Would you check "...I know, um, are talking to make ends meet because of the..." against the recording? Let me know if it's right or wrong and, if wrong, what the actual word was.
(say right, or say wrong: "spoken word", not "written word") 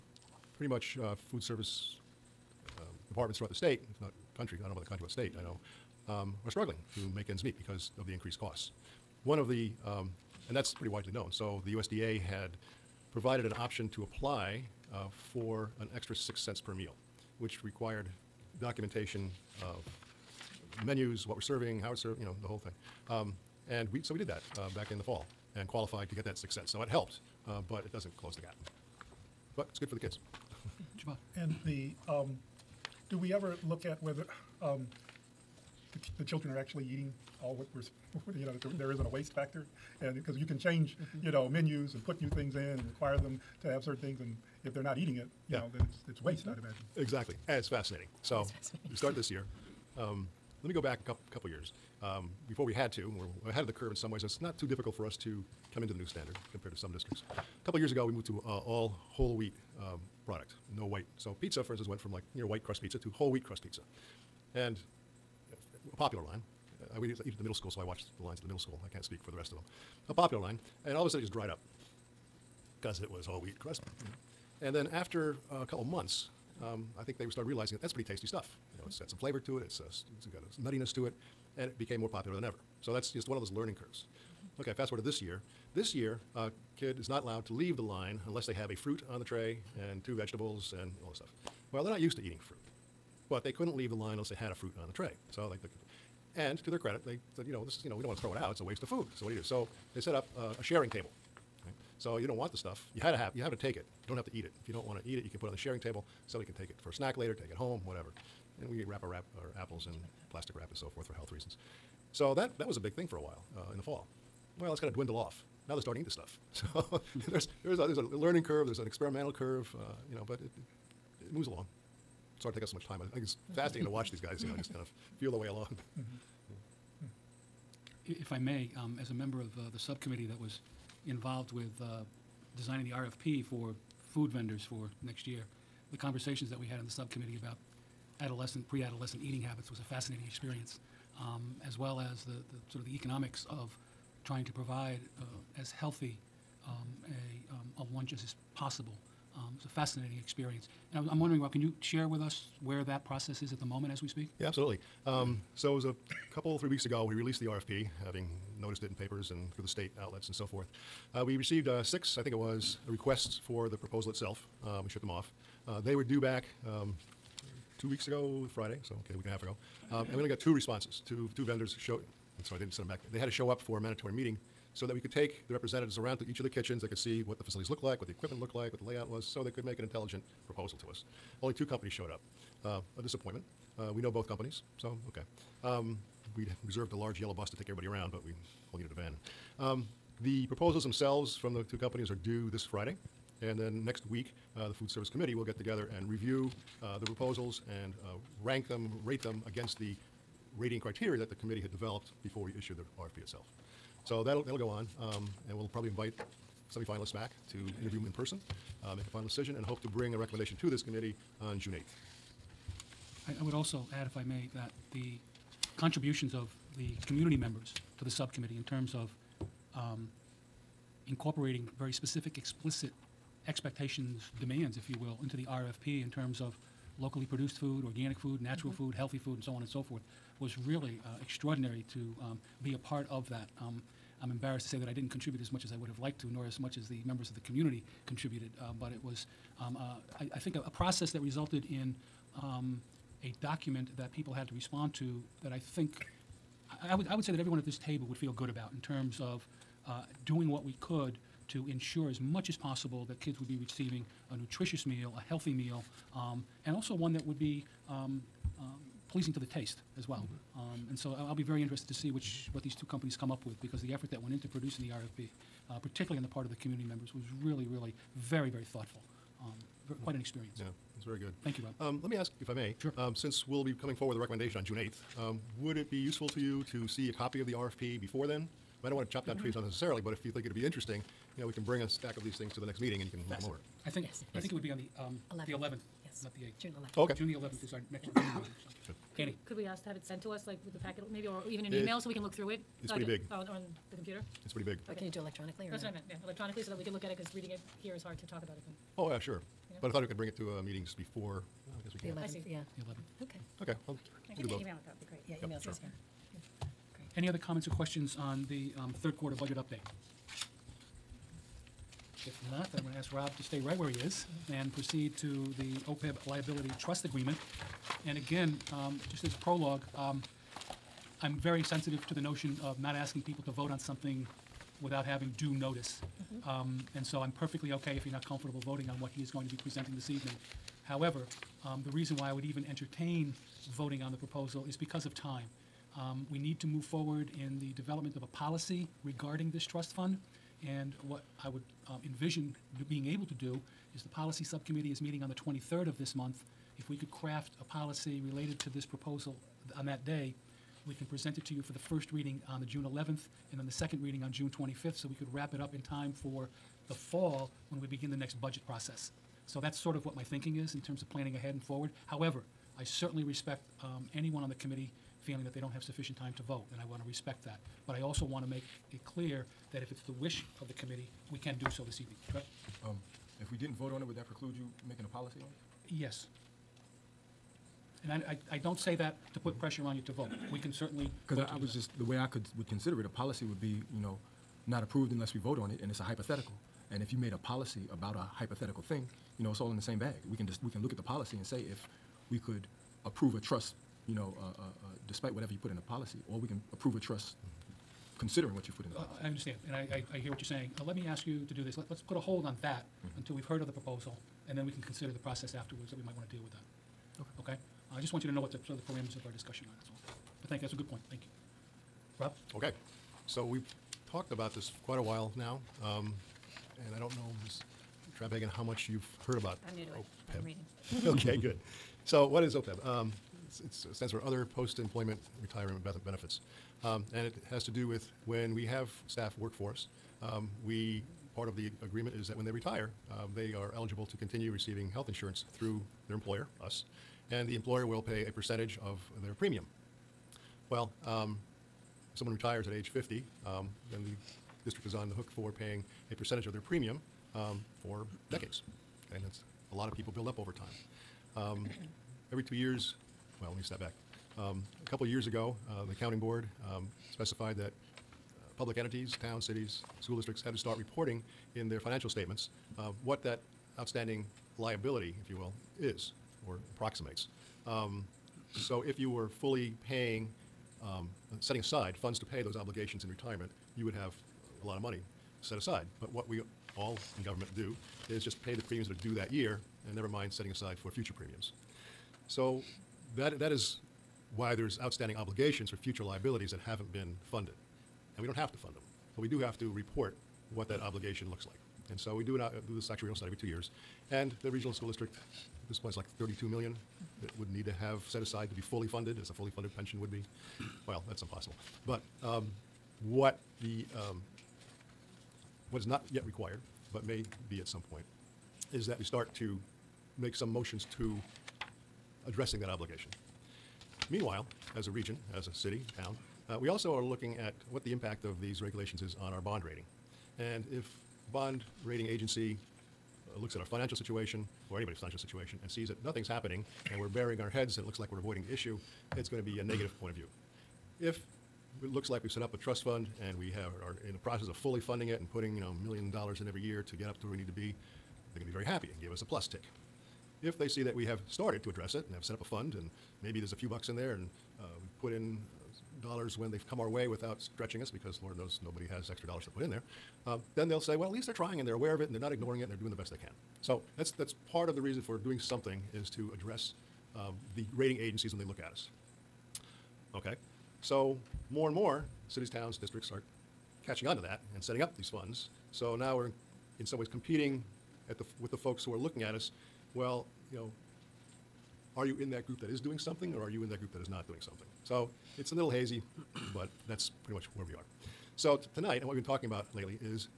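wrong: "struggling", not "talking".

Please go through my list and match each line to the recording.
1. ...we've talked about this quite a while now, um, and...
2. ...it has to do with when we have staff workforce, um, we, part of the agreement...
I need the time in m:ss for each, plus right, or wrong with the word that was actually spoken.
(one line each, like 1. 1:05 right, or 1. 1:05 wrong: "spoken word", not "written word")
1. 6:53 right
2. 7:07 right.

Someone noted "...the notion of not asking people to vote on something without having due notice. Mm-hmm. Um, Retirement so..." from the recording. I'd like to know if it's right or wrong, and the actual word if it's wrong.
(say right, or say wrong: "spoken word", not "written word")
wrong: "And", not "Retirement".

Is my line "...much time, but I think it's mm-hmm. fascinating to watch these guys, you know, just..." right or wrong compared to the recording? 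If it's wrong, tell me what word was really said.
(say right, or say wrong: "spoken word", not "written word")
right.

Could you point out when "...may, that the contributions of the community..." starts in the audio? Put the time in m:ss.
3:34.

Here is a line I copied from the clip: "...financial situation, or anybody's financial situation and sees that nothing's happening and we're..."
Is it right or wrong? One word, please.
right.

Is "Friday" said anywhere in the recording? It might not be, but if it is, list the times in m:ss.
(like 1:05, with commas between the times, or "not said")
2:48, 3:12.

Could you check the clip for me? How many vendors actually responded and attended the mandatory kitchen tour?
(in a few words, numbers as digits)
2.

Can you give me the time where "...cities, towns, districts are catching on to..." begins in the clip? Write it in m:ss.
9:22.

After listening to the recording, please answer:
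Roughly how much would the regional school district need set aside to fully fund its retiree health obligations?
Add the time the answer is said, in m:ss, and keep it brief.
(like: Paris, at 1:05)
32 million, at 8:16.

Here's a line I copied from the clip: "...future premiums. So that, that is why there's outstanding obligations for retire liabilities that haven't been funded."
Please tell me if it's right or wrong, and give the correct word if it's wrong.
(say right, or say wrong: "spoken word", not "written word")
wrong: "future", not "retire".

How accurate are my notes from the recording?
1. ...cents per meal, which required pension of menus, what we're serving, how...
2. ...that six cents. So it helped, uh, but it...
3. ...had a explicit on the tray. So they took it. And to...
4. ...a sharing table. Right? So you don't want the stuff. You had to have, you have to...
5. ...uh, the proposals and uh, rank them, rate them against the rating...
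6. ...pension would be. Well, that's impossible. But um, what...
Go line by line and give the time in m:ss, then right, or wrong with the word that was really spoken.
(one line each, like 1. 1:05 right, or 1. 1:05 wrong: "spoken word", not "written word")
1. 0:16 wrong: "documentation", not "pension"
2. 0:26 right
3. 1:34 wrong: "fruit", not "explicit"
4. 1:40 right
5. 3:16 right
6. 8:19 right.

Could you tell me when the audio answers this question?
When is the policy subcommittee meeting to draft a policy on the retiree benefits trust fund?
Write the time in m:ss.
5:45.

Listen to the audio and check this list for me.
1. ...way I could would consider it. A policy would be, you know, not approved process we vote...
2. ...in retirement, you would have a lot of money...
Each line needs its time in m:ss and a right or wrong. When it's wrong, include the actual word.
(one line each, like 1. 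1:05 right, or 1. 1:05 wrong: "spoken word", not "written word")
1. 6:22 wrong: "unless", not "process"
2. 7:53 right.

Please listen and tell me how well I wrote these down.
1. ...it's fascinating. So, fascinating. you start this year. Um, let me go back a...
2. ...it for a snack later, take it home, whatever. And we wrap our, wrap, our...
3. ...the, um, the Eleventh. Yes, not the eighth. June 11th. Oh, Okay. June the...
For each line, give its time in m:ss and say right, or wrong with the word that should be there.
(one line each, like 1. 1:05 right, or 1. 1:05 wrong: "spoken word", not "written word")
1. 0:47 right
2. 1:46 right
3. 4:44 right.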